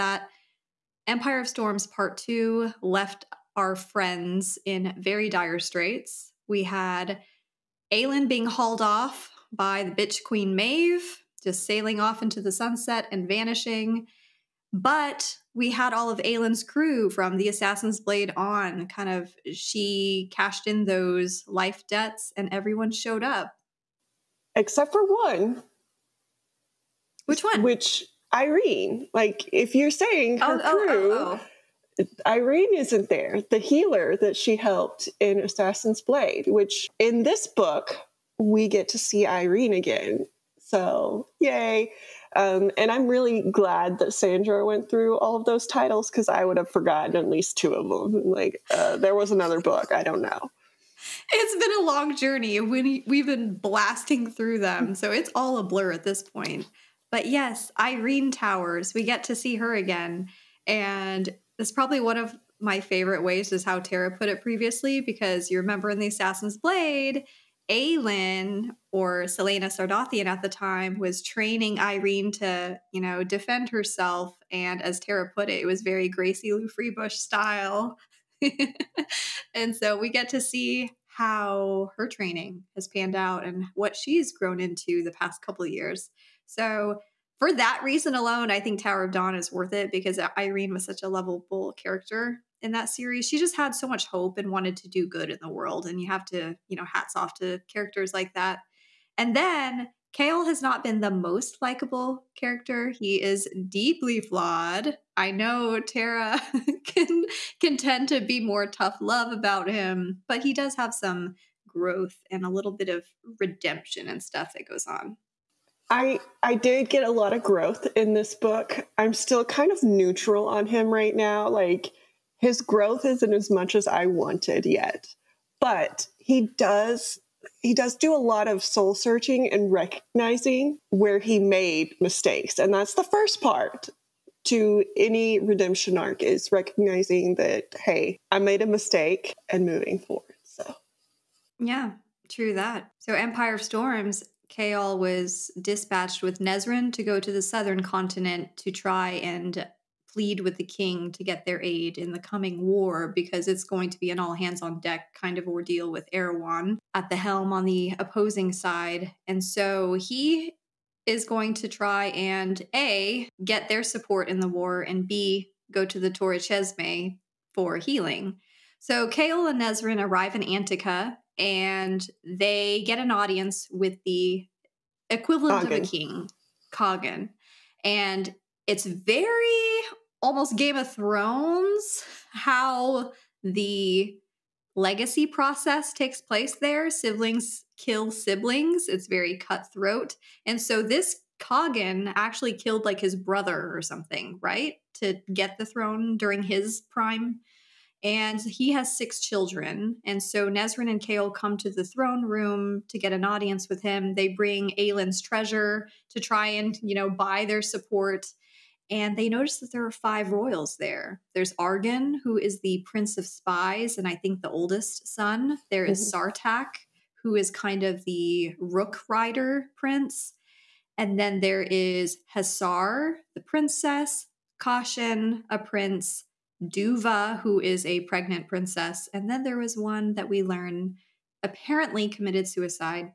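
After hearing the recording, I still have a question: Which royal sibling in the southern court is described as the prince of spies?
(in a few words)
Arghun.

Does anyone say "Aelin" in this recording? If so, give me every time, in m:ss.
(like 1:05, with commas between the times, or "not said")
0:07, 0:16, 1:07, 3:24.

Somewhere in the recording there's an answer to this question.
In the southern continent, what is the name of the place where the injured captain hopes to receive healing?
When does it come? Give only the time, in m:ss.
2:46.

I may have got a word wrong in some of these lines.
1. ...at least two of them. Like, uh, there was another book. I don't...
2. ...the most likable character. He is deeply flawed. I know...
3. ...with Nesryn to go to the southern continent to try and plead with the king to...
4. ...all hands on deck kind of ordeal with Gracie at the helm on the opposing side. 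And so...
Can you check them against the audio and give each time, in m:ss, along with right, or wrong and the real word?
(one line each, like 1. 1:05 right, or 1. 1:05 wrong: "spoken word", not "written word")
1. 0:47 right
2. 1:41 right
3. 2:26 right
4. 2:34 wrong: "Erawan", not "Gracie".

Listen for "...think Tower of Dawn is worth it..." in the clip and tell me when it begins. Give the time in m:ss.
1:28.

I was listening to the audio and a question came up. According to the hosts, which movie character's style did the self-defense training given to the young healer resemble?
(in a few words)
Gracie Lou Freebush.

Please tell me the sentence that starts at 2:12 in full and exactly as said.
And that's the first part to any redemption arc is recognizing that, hey, I made a mistake and moving forward.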